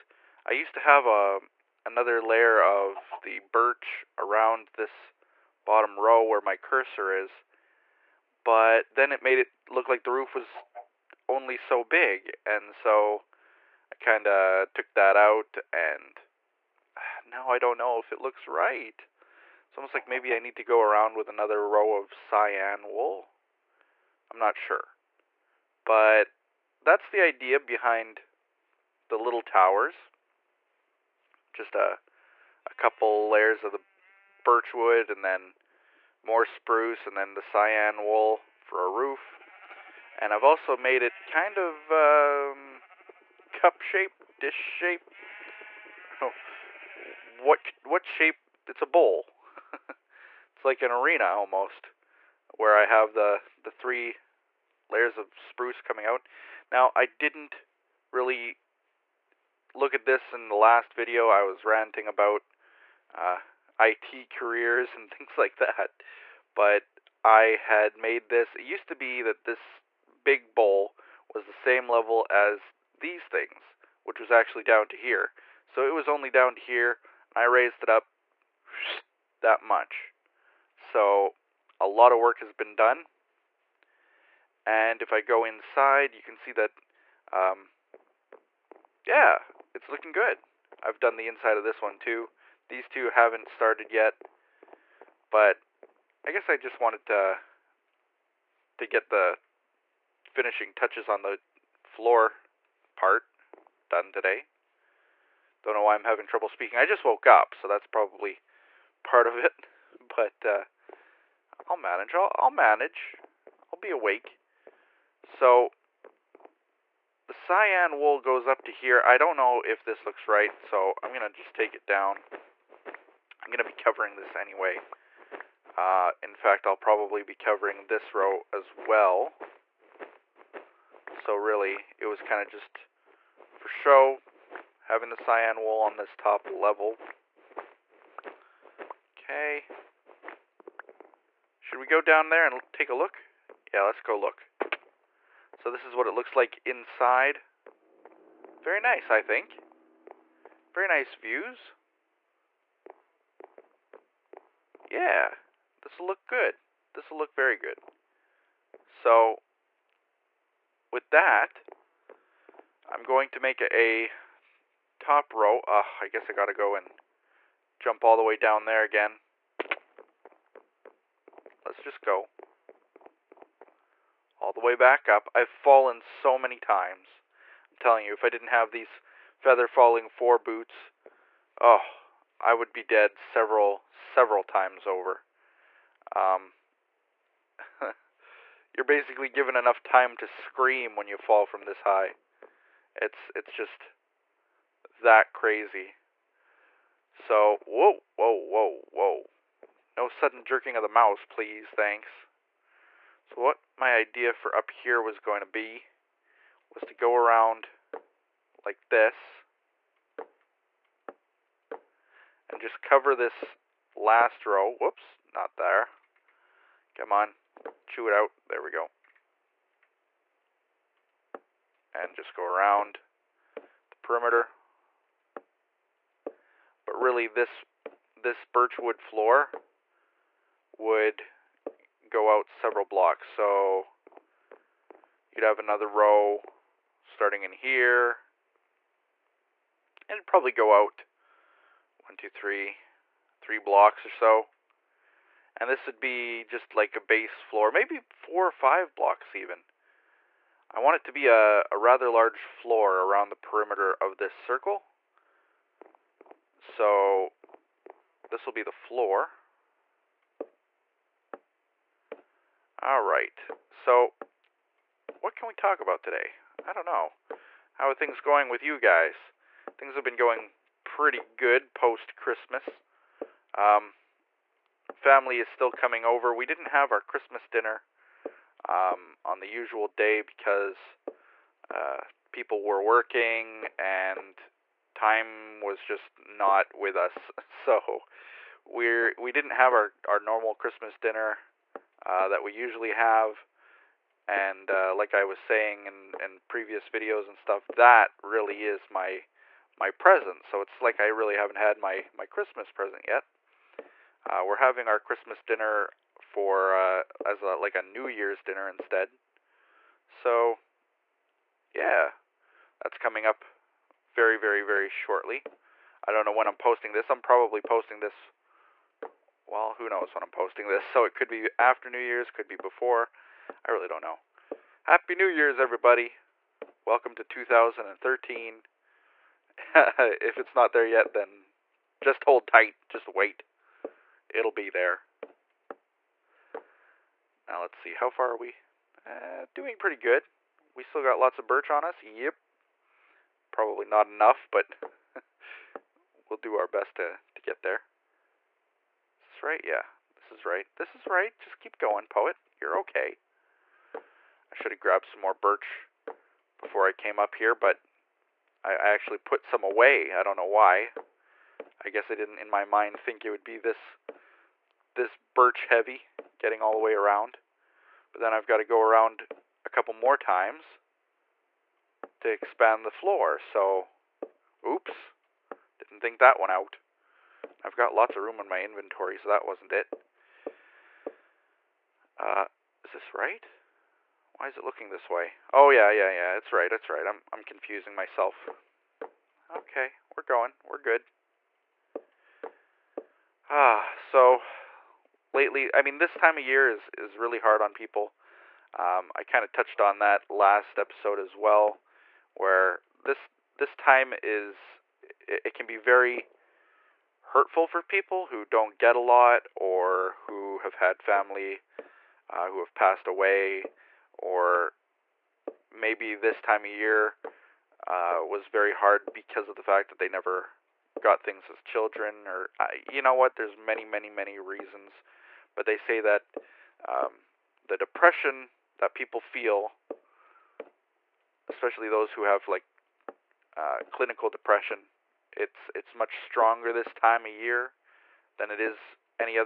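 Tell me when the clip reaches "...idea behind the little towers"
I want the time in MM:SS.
00:27.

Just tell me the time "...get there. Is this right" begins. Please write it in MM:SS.
05:47.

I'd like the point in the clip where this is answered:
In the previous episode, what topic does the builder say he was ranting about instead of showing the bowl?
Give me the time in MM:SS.
01:03.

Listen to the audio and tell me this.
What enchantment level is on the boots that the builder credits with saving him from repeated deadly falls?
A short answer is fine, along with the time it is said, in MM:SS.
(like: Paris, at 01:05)
Feather Falling 4, at 02:59.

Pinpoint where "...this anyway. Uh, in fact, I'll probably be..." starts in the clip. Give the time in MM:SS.
02:04.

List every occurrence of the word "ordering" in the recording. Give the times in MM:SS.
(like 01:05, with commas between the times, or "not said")
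not said.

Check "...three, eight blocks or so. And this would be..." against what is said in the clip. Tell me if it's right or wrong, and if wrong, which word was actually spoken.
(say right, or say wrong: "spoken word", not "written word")
wrong: "three", not "eight".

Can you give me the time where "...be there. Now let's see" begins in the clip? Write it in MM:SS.
05:34.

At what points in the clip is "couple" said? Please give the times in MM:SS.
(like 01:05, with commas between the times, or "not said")
00:32, 06:09.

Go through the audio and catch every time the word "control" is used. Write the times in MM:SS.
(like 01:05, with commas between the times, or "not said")
not said.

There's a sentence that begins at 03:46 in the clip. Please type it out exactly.
But really this this birchwood floor would go out several blocks.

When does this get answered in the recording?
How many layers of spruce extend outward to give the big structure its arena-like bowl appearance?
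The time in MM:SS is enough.
00:53.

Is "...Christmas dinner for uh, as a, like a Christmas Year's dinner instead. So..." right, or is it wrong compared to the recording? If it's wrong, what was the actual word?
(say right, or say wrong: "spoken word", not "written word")
wrong: "New", not "Christmas".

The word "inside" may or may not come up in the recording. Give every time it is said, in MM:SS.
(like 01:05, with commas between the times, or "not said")
01:25, 01:31, 02:26.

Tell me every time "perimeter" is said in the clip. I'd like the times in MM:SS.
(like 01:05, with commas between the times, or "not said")
03:44, 04:13.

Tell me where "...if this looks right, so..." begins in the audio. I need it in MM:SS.
01:59.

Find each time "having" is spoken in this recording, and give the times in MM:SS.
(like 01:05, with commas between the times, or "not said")
01:46, 02:14, 05:04.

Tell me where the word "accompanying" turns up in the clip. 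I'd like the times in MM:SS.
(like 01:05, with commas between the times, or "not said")
not said.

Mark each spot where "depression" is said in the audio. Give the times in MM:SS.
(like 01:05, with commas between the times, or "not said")
07:07, 07:14.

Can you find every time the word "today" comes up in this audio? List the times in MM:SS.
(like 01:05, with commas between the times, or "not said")
01:44, 04:26.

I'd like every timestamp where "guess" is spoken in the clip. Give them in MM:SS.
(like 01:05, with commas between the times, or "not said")
01:36, 02:46, 06:01.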